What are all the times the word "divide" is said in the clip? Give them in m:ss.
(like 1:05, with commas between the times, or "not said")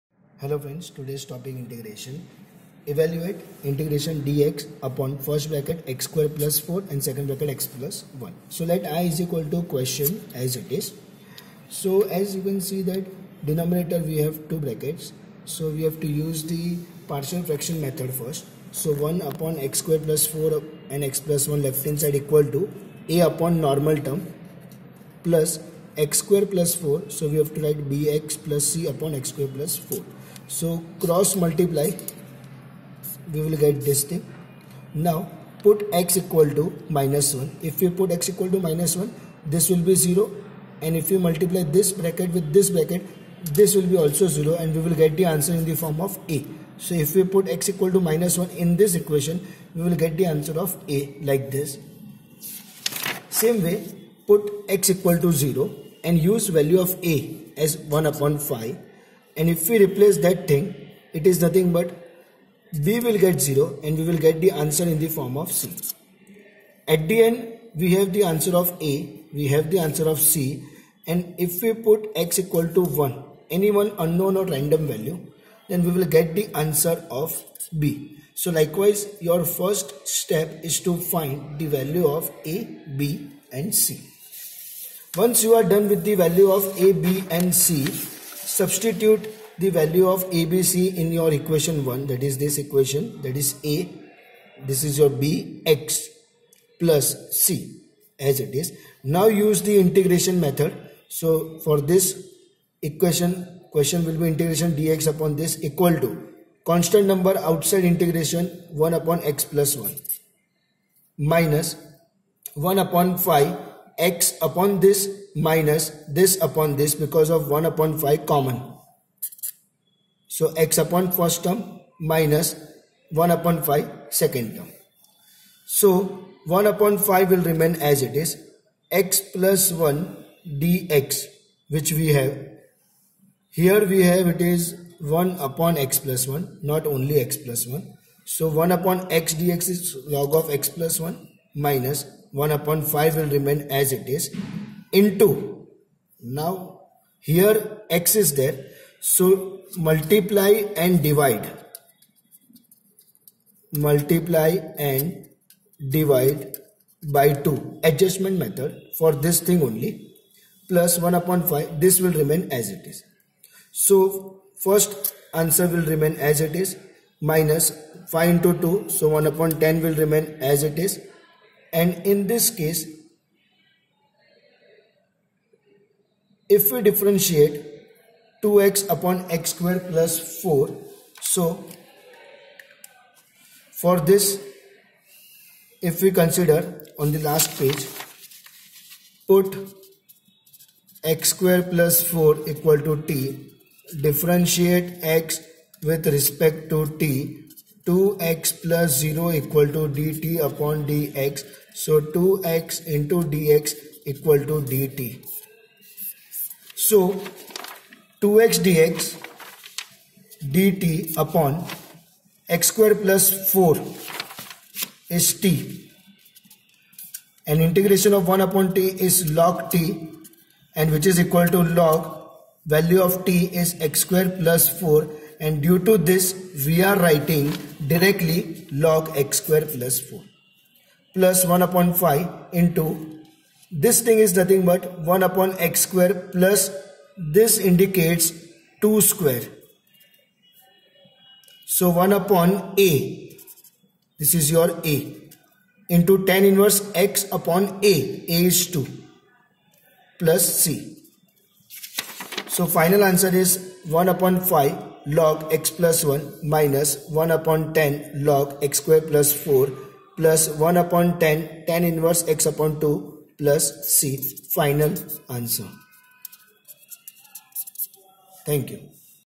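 2:31, 2:35.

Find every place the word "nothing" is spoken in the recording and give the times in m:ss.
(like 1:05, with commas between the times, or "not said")
1:01, 3:54.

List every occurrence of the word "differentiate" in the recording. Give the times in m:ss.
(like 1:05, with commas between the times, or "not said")
2:56, 3:14.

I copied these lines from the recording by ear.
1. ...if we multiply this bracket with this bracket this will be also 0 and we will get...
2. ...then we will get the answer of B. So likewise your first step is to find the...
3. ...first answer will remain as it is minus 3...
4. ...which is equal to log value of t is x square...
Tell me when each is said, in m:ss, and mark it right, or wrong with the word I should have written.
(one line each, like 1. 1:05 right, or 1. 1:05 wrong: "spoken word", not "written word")
1. 0:41 right
2. 1:15 right
3. 2:44 wrong: "5", not "3"
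4. 3:40 right.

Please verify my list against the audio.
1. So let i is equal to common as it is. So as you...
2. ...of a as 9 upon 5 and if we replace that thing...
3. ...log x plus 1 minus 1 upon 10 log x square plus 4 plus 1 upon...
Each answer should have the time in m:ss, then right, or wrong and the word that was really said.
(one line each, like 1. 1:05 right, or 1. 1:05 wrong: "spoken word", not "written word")
1. 0:08 wrong: "question", not "common"
2. 0:56 wrong: "1", not "9"
3. 4:15 right.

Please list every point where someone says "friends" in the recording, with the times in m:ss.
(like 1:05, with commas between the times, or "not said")
0:00.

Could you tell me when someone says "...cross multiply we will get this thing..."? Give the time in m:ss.
0:30.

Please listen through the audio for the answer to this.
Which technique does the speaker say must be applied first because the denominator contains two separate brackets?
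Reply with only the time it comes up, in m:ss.
0:17.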